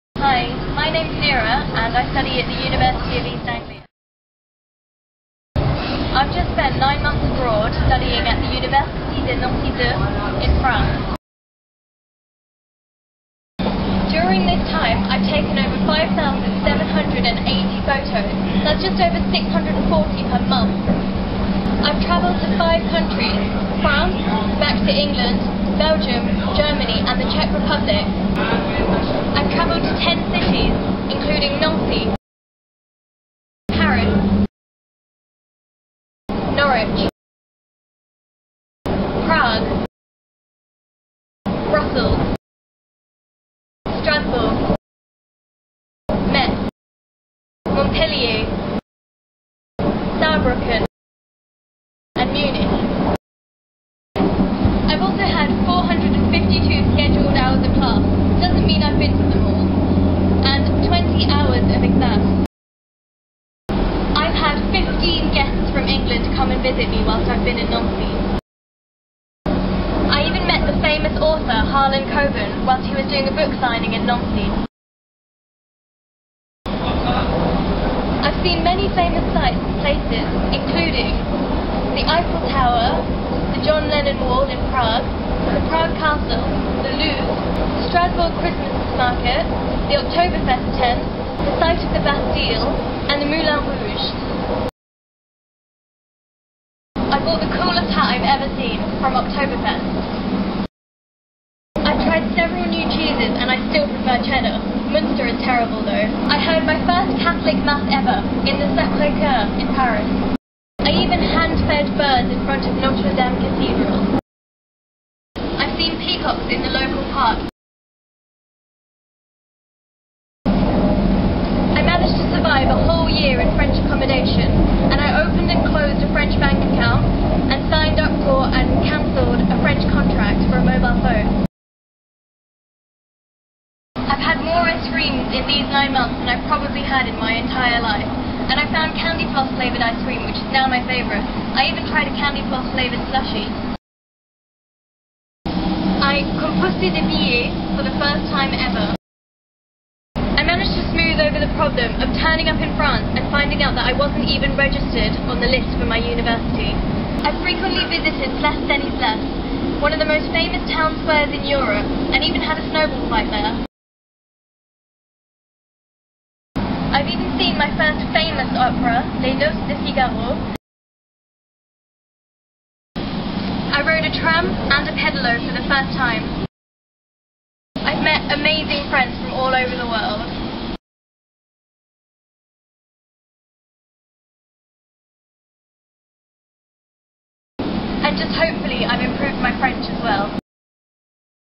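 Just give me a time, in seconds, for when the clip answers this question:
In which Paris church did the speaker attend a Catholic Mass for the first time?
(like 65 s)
108 s.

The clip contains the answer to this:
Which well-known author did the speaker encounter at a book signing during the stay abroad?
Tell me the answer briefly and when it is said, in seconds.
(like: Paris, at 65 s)
Harlan Coben, at 71 s.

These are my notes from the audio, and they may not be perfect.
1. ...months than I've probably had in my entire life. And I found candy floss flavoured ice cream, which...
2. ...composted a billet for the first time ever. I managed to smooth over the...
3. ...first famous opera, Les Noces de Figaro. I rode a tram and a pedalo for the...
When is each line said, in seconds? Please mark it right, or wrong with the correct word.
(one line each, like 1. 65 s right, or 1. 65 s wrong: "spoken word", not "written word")
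1. 135 s right
2. 146 s right
3. 167 s right.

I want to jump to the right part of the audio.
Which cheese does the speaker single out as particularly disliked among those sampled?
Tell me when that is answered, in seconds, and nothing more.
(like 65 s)
104 s.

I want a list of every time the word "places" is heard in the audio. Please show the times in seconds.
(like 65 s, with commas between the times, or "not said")
79 s, 158 s.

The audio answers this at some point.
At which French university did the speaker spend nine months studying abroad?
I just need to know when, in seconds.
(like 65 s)
8 s.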